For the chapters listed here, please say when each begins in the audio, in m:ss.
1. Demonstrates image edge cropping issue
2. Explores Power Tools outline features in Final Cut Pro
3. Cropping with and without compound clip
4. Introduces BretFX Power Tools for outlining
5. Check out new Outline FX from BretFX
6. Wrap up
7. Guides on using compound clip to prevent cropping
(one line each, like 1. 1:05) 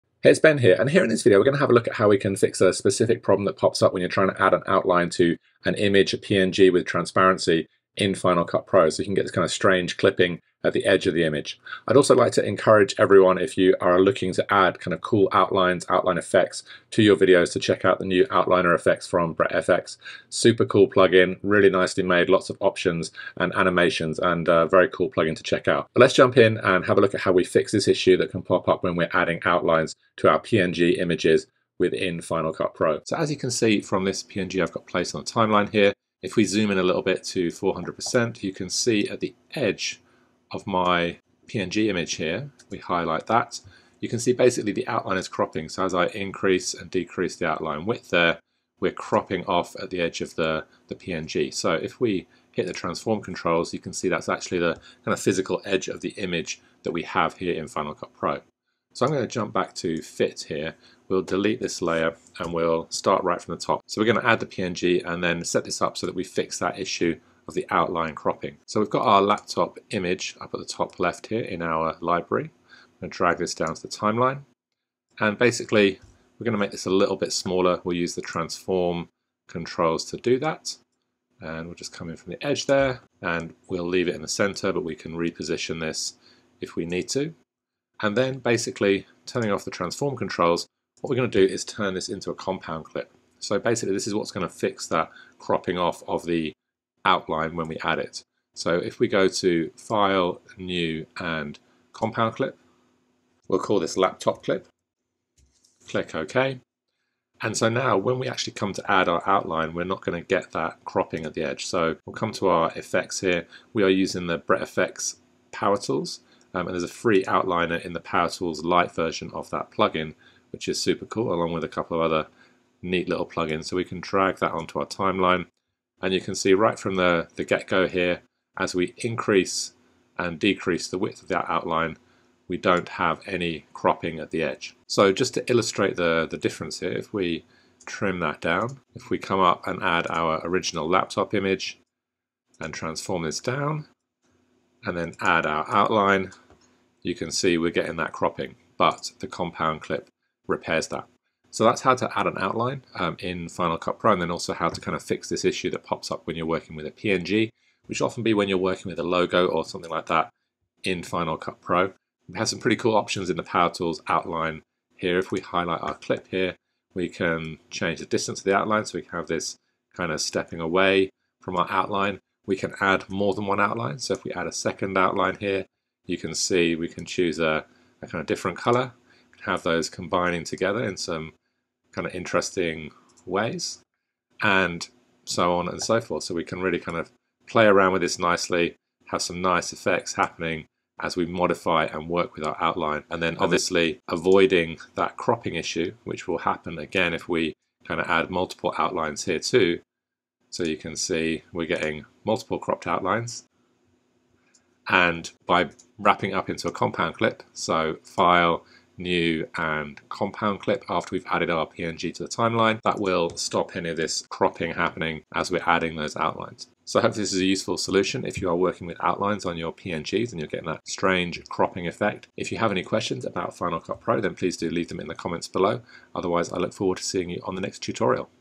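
1. 1:01
2. 2:45
3. 2:23
4. 2:01
5. 0:15
6. 3:32
7. 1:41.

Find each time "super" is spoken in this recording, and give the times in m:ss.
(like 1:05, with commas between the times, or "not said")
0:20, 2:00.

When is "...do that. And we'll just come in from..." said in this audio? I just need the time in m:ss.
1:20.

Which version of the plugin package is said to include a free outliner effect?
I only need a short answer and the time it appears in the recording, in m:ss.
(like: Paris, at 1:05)
Power Tools Lite, at 1:57.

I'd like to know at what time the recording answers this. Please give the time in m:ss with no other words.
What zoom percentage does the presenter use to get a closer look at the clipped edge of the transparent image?
0:37.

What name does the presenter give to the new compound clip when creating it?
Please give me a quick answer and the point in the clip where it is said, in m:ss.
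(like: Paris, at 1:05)
Laptop Clip, at 1:43.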